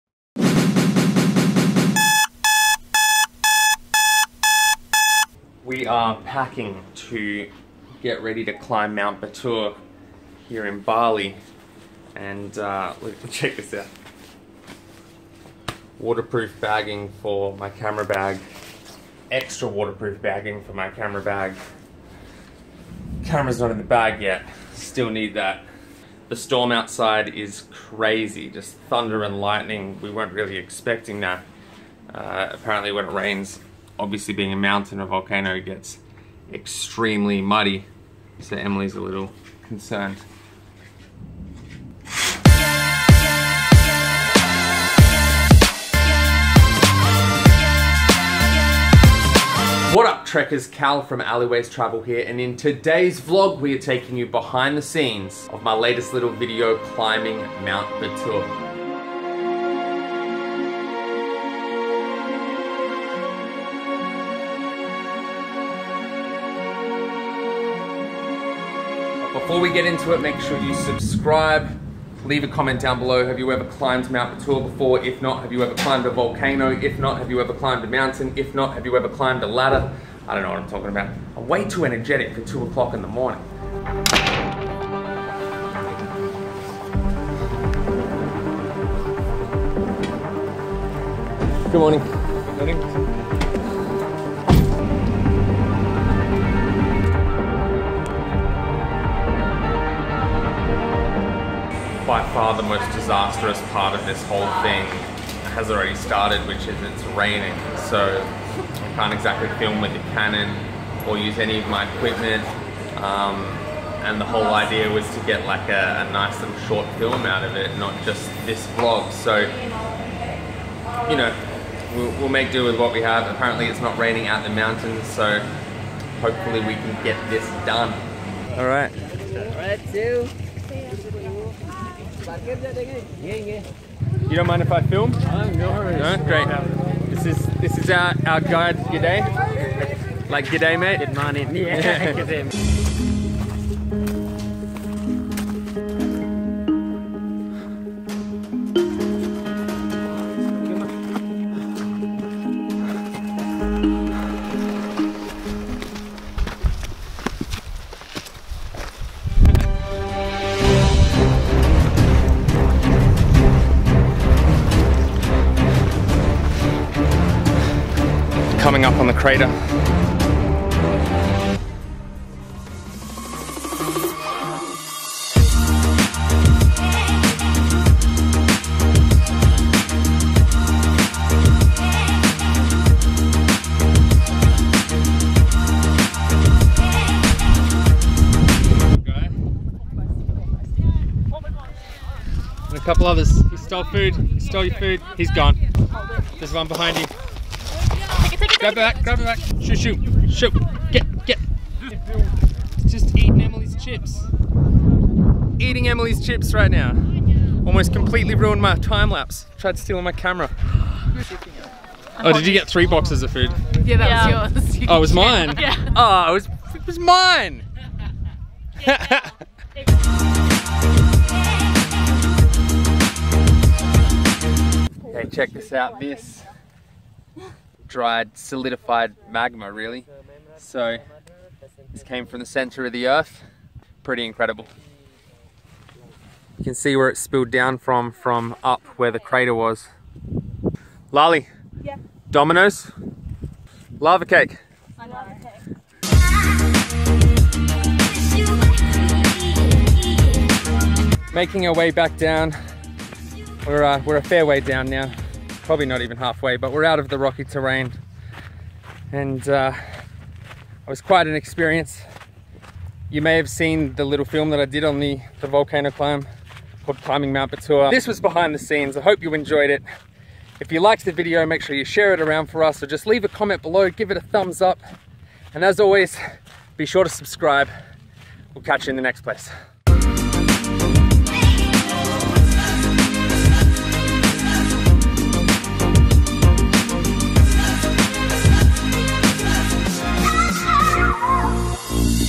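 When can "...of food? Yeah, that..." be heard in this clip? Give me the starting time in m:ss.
3:33.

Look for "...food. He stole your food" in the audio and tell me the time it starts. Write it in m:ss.
3:13.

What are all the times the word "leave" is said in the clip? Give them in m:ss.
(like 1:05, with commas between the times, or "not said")
1:12, 4:33.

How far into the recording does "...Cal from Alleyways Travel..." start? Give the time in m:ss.
0:50.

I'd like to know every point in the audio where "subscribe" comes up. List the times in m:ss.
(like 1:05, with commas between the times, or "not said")
1:10, 4:37.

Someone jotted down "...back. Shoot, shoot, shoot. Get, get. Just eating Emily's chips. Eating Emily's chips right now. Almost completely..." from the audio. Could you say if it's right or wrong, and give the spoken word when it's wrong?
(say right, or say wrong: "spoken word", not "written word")
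right.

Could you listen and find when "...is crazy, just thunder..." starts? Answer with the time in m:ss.
0:27.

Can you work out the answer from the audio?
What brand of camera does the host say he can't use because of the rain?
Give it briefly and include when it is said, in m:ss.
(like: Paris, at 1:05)
Canon, at 1:50.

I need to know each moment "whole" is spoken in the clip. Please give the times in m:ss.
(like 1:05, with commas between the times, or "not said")
1:44, 1:54.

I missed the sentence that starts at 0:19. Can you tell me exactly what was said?
Extra waterproof bagging for my camera bag.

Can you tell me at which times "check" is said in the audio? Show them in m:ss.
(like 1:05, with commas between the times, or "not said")
0:13, 3:45.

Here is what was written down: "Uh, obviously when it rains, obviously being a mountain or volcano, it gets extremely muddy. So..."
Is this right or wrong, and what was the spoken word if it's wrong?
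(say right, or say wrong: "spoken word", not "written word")
wrong: "apparently", not "obviously".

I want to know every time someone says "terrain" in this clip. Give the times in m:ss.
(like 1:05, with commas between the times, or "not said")
4:17.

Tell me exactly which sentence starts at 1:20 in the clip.
I don't know what I'm talking about.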